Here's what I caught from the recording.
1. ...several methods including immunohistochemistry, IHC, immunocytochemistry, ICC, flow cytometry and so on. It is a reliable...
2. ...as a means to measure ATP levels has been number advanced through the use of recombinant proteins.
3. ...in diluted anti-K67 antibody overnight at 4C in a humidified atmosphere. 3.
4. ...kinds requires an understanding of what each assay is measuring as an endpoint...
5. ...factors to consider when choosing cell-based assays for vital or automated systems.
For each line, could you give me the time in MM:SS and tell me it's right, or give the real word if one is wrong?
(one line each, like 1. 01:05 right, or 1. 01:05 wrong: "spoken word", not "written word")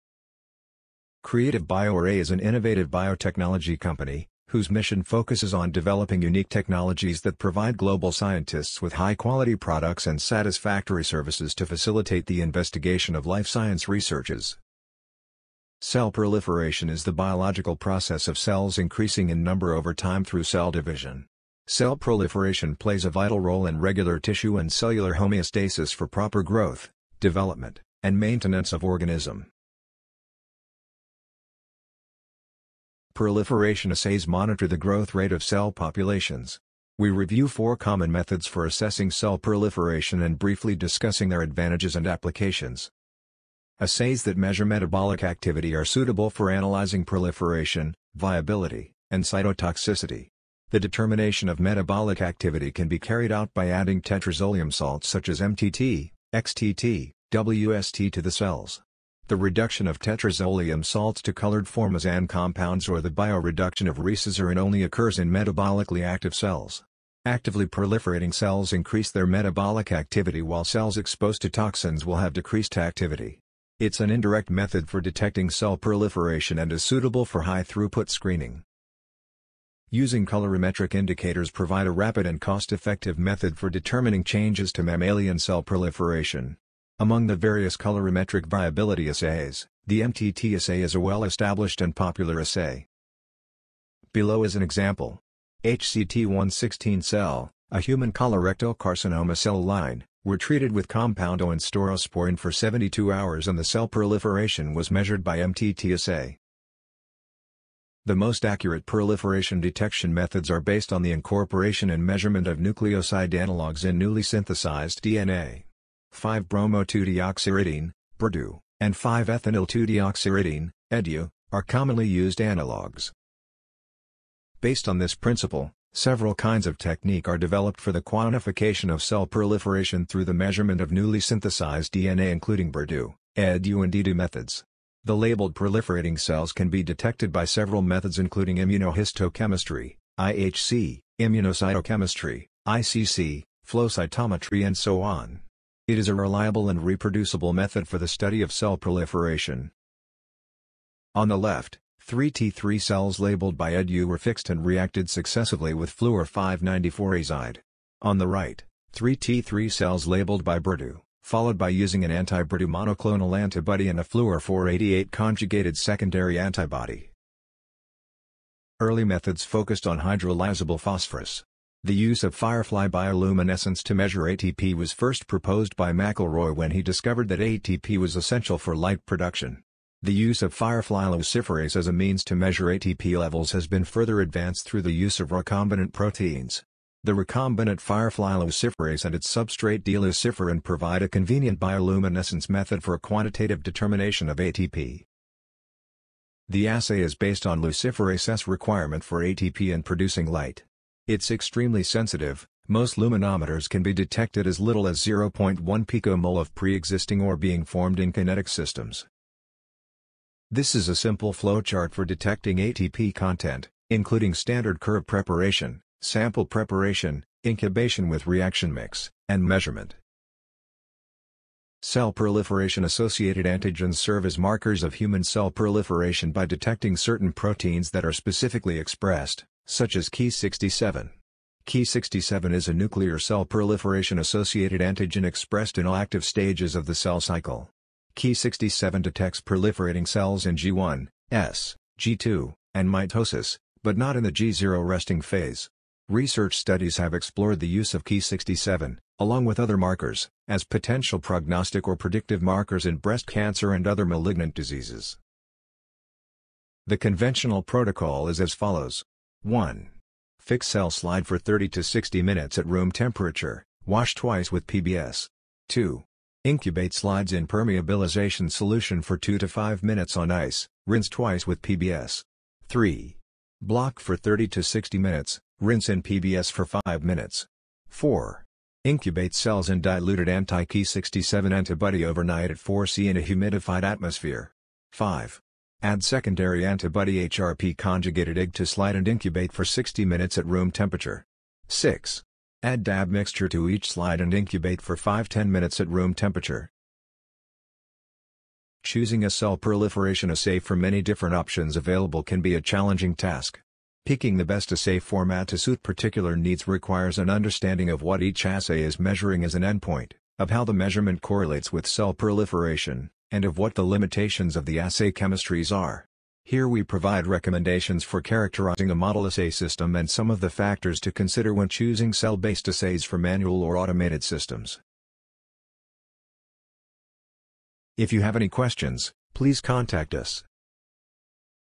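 1. 02:17 right
2. 03:01 wrong: "further", not "number"
3. 04:39 wrong: "5", not "3"
4. 05:06 wrong: "needs", not "kinds"
5. 05:20 wrong: "manual", not "vital".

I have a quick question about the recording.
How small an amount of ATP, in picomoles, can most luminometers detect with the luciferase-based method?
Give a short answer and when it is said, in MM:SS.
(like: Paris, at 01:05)
0.1 picomole, at 03:25.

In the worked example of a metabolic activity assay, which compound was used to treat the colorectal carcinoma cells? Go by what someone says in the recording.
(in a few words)
staurosporine.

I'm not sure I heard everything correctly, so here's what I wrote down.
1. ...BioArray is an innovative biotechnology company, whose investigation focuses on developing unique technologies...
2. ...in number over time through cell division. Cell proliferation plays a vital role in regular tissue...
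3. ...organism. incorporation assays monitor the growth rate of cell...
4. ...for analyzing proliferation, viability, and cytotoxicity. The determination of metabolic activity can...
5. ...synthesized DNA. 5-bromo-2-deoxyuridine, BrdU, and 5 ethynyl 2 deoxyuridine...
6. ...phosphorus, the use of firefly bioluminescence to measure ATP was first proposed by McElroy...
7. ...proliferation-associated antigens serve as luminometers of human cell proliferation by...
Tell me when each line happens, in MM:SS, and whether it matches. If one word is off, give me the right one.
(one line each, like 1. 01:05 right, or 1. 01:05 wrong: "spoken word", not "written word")
1. 00:01 wrong: "mission", not "investigation"
2. 00:19 right
3. 00:28 wrong: "proliferation", not "incorporation"
4. 00:46 right
5. 01:54 right
6. 02:50 right
7. 03:42 wrong: "markers", not "luminometers".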